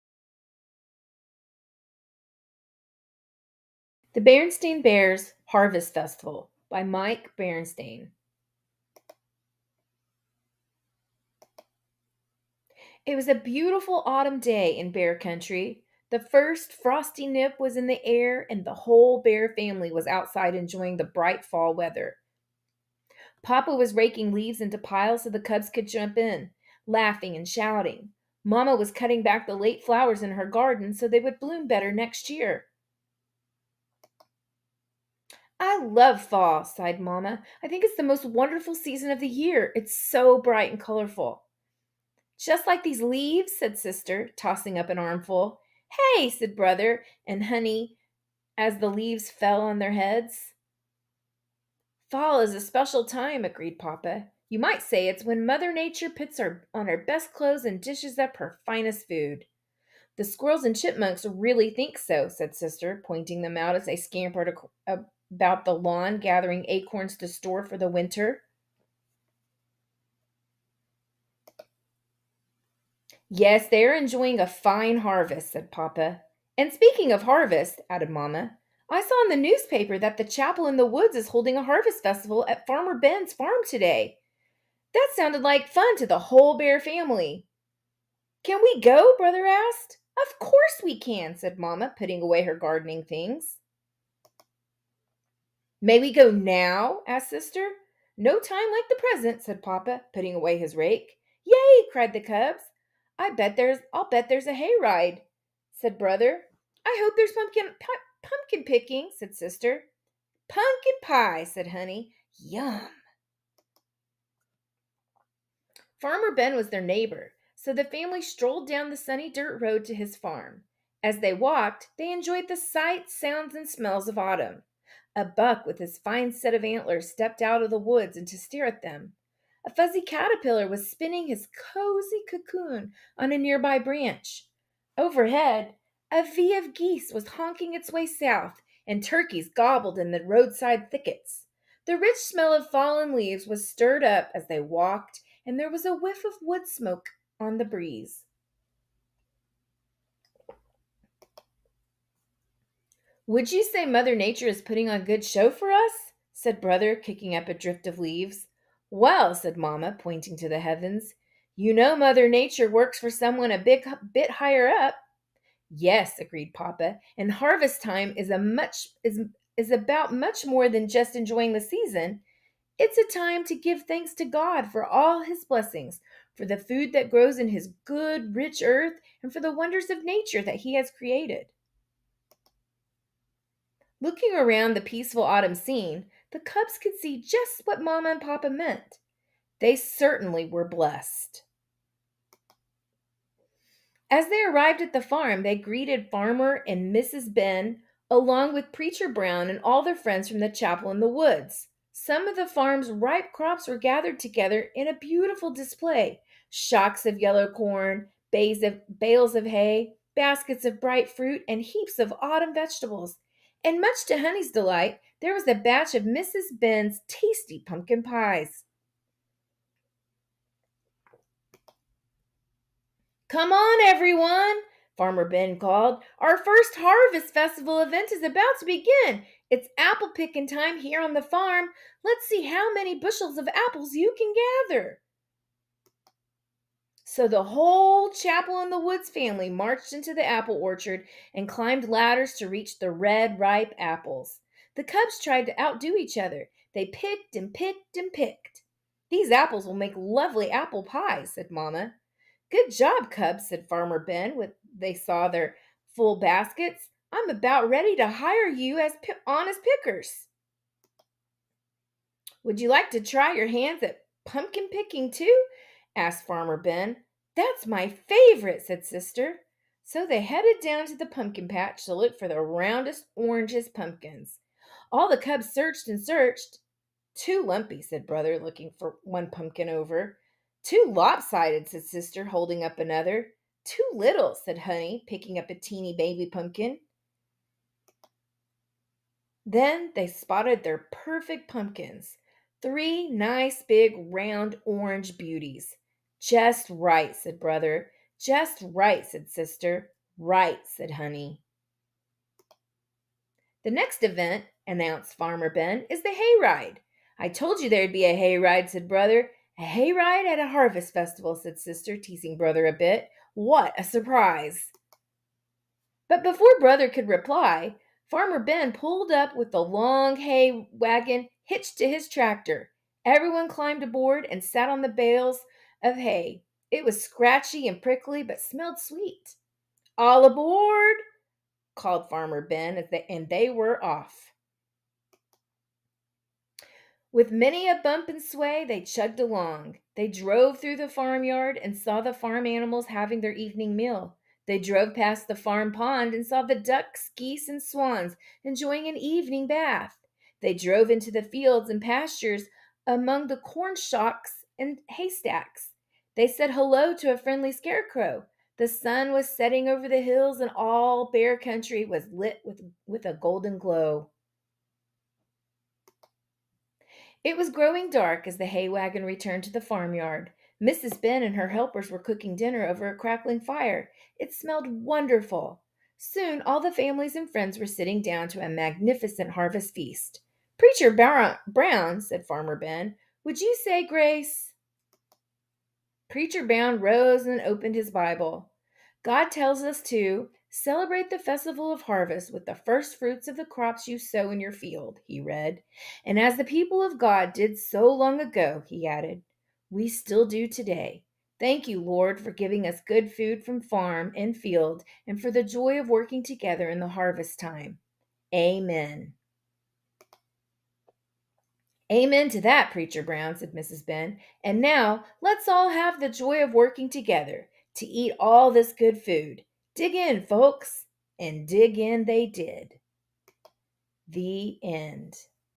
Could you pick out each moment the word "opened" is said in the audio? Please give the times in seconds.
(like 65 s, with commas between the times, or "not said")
387 s.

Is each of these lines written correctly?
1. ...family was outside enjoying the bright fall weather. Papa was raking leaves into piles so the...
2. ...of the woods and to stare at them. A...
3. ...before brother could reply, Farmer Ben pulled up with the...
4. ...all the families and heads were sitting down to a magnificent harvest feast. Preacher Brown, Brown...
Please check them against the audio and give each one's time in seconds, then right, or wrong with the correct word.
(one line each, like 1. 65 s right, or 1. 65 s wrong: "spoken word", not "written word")
1. 19 s right
2. 127 s right
3. 316 s right
4. 376 s wrong: "friends", not "heads".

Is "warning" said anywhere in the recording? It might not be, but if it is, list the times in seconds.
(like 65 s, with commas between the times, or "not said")
not said.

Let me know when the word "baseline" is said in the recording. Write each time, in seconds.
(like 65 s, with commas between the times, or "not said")
not said.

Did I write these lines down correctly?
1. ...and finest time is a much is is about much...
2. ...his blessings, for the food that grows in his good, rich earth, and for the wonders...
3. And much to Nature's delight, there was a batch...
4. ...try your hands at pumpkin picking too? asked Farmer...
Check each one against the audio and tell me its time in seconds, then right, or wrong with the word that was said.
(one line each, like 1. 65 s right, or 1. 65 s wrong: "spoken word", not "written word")
1. 167 s wrong: "harvest", not "finest"
2. 175 s right
3. 213 s wrong: "Honey", not "Nature"
4. 263 s right.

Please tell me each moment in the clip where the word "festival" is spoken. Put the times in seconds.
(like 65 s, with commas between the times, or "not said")
5 s, 82 s, 227 s, 310 s, 391 s.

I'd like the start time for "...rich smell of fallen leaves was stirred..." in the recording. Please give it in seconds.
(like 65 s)
141 s.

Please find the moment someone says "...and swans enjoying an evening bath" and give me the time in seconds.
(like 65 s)
347 s.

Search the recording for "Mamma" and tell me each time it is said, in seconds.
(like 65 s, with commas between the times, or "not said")
36 s, 78 s, 91 s, 159 s, 251 s.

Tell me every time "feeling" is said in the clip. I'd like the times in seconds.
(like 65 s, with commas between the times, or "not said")
not said.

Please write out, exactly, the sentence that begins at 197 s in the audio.
Ben, along with Preacher Brown and all their friends from the chapel in the woods.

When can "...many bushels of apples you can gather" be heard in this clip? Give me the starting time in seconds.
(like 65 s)
232 s.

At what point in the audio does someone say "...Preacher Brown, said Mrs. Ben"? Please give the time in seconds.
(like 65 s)
412 s.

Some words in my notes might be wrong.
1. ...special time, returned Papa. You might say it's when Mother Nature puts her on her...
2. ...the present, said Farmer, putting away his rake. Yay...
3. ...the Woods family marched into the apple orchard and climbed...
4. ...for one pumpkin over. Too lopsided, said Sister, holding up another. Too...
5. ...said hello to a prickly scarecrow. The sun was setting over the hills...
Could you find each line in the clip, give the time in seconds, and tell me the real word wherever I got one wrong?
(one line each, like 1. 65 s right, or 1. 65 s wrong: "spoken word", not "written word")
1. 52 s wrong: "agreed", not "returned"
2. 98 s wrong: "Papa", not "Farmer"
3. 238 s right
4. 278 s right
5. 356 s wrong: "friendly", not "prickly".